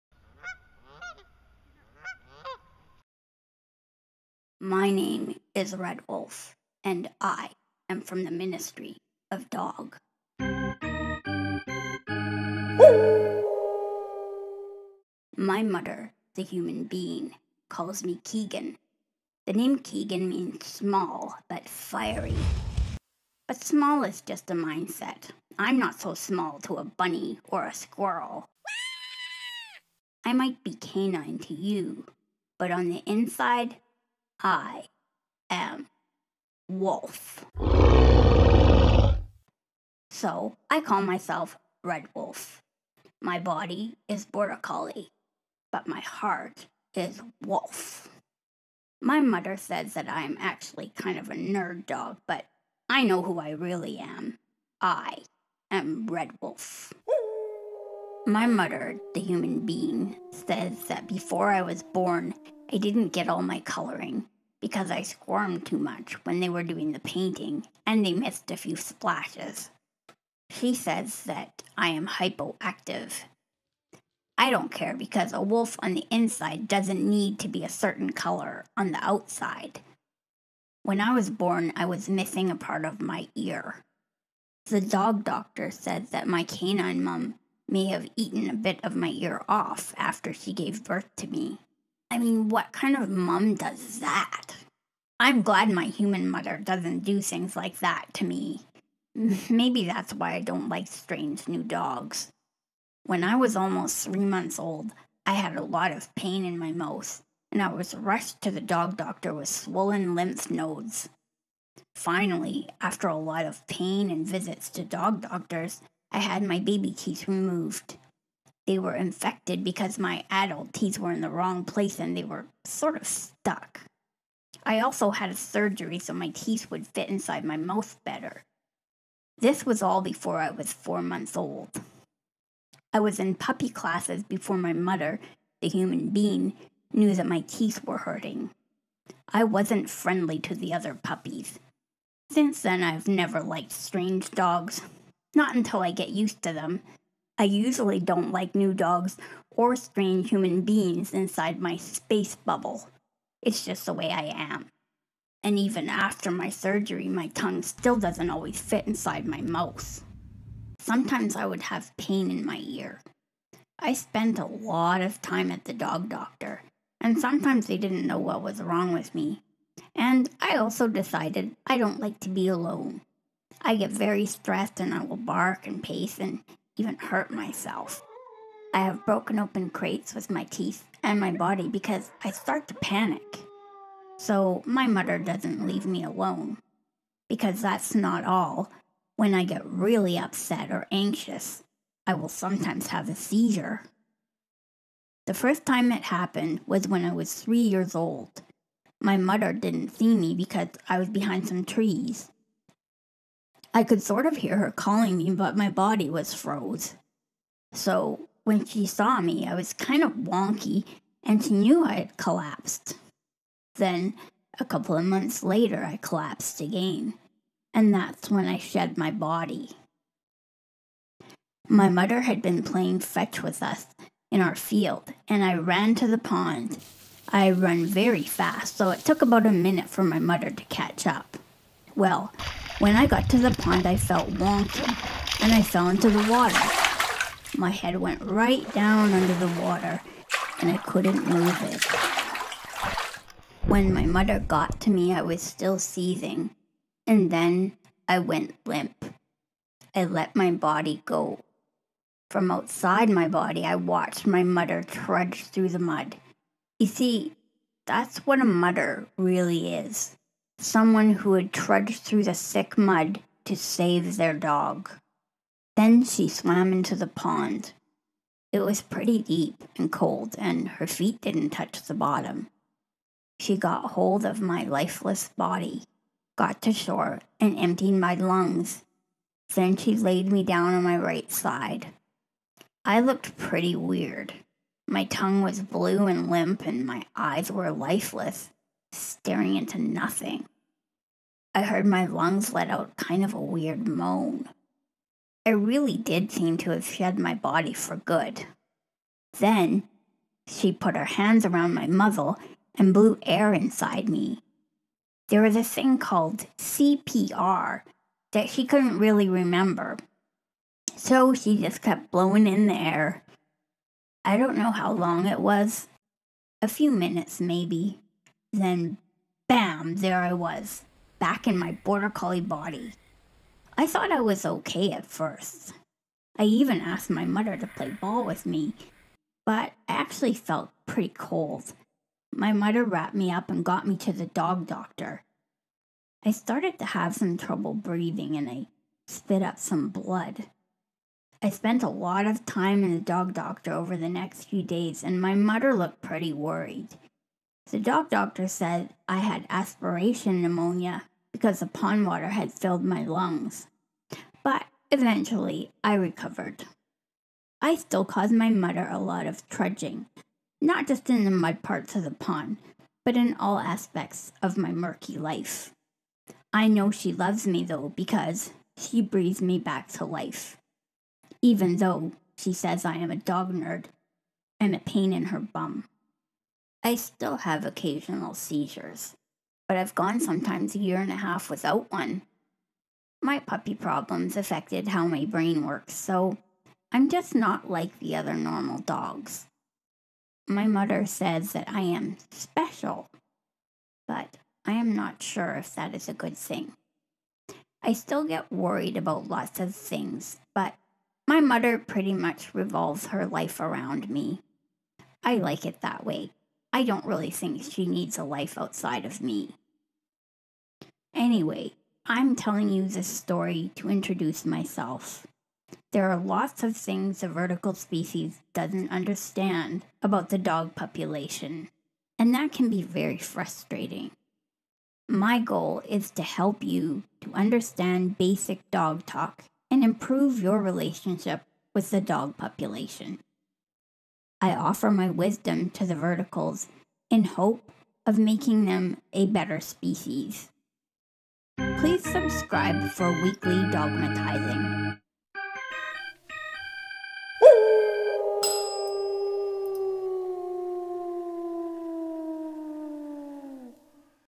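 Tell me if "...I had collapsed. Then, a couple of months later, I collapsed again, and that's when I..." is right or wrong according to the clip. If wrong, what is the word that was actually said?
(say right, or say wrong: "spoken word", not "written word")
right.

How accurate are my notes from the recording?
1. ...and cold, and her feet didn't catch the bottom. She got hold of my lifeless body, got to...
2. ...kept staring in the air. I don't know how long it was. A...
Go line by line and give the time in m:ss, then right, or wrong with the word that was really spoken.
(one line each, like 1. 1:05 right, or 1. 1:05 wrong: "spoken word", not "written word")
1. 4:29 wrong: "touch", not "catch"
2. 5:11 wrong: "blowing", not "staring".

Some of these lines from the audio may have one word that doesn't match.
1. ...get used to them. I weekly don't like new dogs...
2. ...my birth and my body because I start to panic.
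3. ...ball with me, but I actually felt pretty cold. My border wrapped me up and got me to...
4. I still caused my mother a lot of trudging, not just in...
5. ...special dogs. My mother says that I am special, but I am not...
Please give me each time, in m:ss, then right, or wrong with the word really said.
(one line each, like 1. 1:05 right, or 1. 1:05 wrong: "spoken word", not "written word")
1. 2:25 wrong: "usually", not "weekly"
2. 3:00 wrong: "teeth", not "birth"
3. 5:27 wrong: "mother", not "border"
4. 5:57 right
5. 6:28 wrong: "normal", not "special".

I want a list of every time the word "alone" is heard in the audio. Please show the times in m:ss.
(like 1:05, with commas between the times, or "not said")
2:52, 3:06.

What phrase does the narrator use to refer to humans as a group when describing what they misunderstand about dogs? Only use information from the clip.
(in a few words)
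the vertical species.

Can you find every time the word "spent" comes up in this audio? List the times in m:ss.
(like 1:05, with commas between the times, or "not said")
2:43, 5:41.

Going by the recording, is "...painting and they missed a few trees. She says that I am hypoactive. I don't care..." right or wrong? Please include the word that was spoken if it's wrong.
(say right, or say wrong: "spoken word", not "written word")
wrong: "splashes", not "trees".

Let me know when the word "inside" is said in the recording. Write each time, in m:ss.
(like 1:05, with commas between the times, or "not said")
0:33, 1:16, 2:07, 2:31, 2:38, 5:03.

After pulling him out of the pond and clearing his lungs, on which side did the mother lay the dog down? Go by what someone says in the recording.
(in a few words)
right side.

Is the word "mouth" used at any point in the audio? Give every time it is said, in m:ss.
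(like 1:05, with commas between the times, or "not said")
1:46, 2:07, 2:39.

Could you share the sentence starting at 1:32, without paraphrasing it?
I mean, what kind of mum does that?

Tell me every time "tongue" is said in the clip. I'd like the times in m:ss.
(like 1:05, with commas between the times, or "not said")
2:37, 4:45.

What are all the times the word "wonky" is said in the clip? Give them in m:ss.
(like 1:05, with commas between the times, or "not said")
3:30, 3:54.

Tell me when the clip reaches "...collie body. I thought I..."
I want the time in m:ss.
5:22.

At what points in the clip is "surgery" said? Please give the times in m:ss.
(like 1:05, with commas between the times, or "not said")
2:05, 2:36.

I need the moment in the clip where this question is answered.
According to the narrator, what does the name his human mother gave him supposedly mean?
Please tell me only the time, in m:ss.
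0:20.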